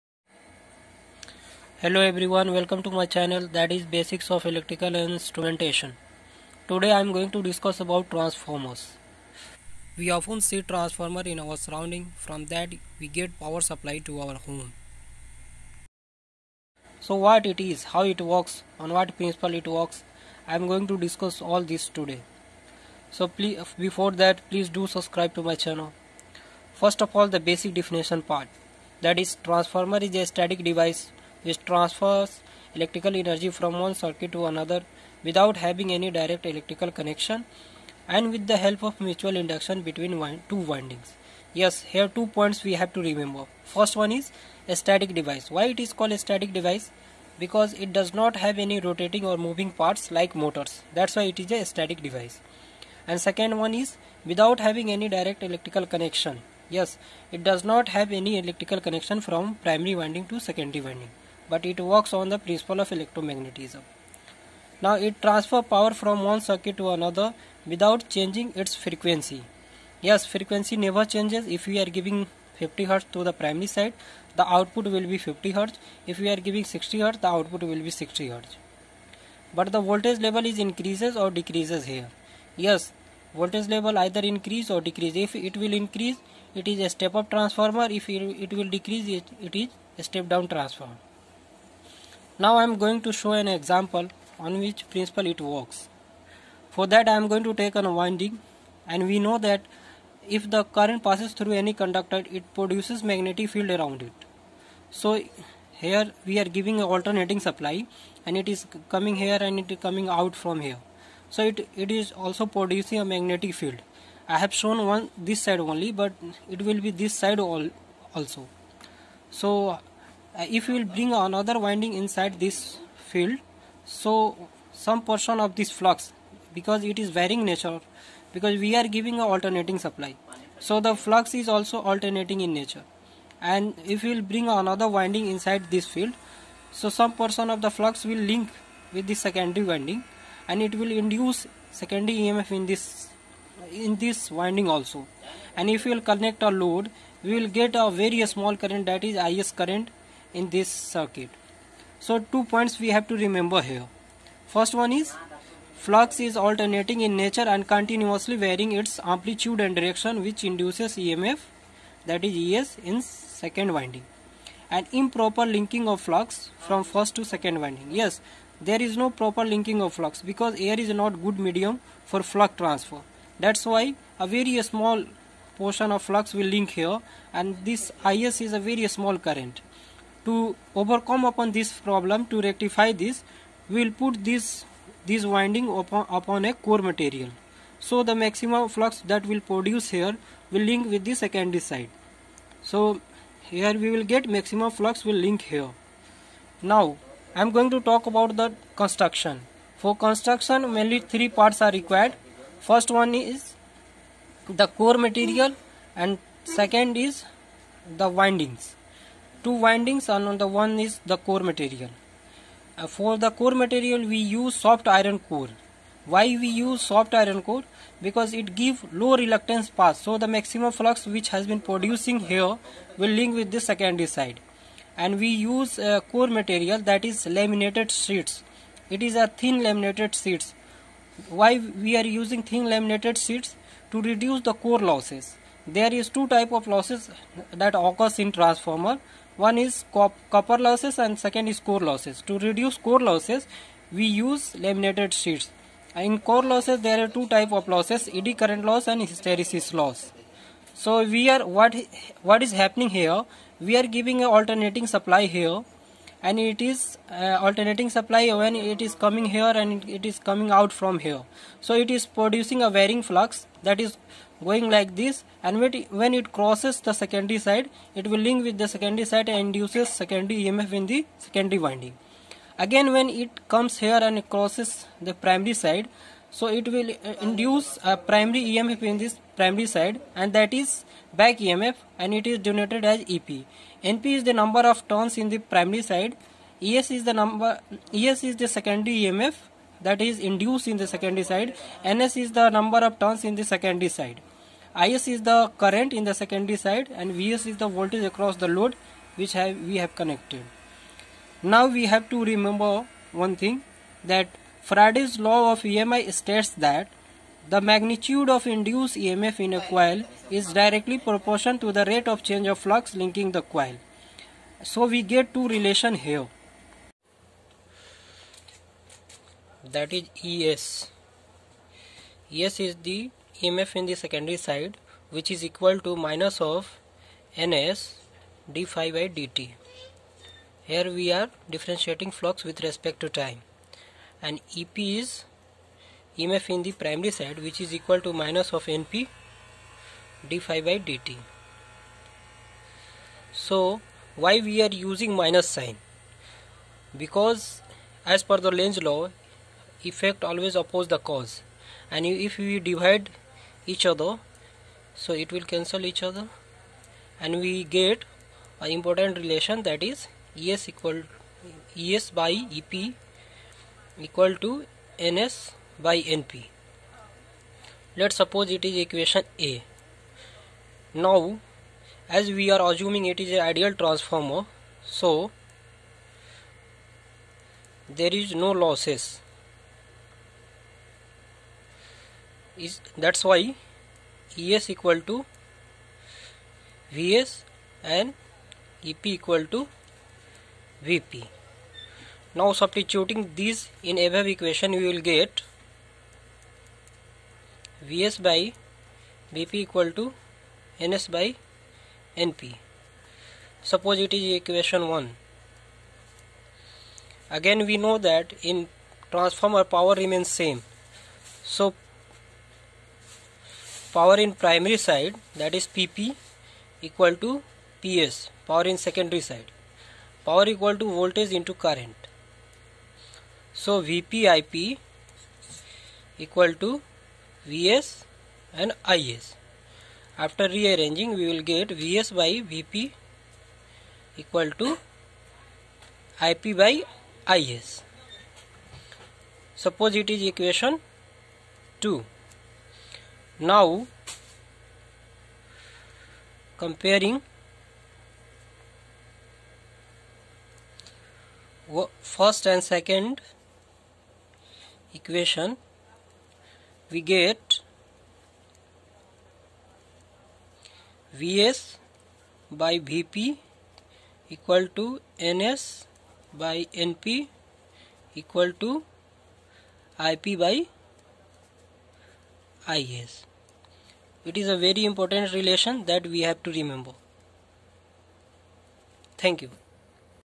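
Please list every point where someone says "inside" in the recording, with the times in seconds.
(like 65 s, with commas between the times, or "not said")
121 s, 135 s.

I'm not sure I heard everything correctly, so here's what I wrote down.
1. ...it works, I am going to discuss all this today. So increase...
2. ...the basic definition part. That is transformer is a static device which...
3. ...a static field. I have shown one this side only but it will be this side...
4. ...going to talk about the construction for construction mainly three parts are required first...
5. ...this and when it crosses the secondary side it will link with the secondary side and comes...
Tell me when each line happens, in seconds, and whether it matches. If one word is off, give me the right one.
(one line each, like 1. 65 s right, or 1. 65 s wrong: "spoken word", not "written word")
1. 19 s wrong: "please", not "increase"
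2. 27 s right
3. 113 s wrong: "magnetic", not "static"
4. 197 s right
5. 264 s wrong: "induces", not "comes".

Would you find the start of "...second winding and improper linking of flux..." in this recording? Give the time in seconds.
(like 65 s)
163 s.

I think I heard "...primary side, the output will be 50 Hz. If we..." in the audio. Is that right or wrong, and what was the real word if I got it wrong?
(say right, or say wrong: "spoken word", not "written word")
right.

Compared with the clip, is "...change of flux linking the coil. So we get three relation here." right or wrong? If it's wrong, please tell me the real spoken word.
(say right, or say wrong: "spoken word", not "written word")
wrong: "two", not "three".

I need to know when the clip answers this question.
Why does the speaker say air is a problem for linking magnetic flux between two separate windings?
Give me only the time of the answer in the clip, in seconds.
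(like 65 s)
170 s.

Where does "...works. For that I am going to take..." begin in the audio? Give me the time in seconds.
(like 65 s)
95 s.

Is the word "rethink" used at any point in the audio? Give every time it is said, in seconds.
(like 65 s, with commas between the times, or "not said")
not said.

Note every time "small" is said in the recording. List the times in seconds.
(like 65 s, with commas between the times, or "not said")
148 s, 174 s, 178 s.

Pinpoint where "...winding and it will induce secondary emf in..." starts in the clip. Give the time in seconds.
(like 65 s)
139 s.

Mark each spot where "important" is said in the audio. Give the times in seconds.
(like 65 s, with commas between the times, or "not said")
358 s, 474 s.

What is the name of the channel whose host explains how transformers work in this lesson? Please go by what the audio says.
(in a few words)
Basics of Electrical Instrumentation.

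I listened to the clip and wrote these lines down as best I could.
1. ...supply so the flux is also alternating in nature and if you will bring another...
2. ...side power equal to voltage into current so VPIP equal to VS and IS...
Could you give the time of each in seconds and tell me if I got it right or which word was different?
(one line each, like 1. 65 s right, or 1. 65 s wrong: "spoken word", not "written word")
1. 129 s right
2. 419 s right.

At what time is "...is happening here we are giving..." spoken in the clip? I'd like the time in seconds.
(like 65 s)
252 s.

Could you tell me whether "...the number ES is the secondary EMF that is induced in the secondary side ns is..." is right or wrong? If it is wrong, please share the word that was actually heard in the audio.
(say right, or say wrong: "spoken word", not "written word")
right.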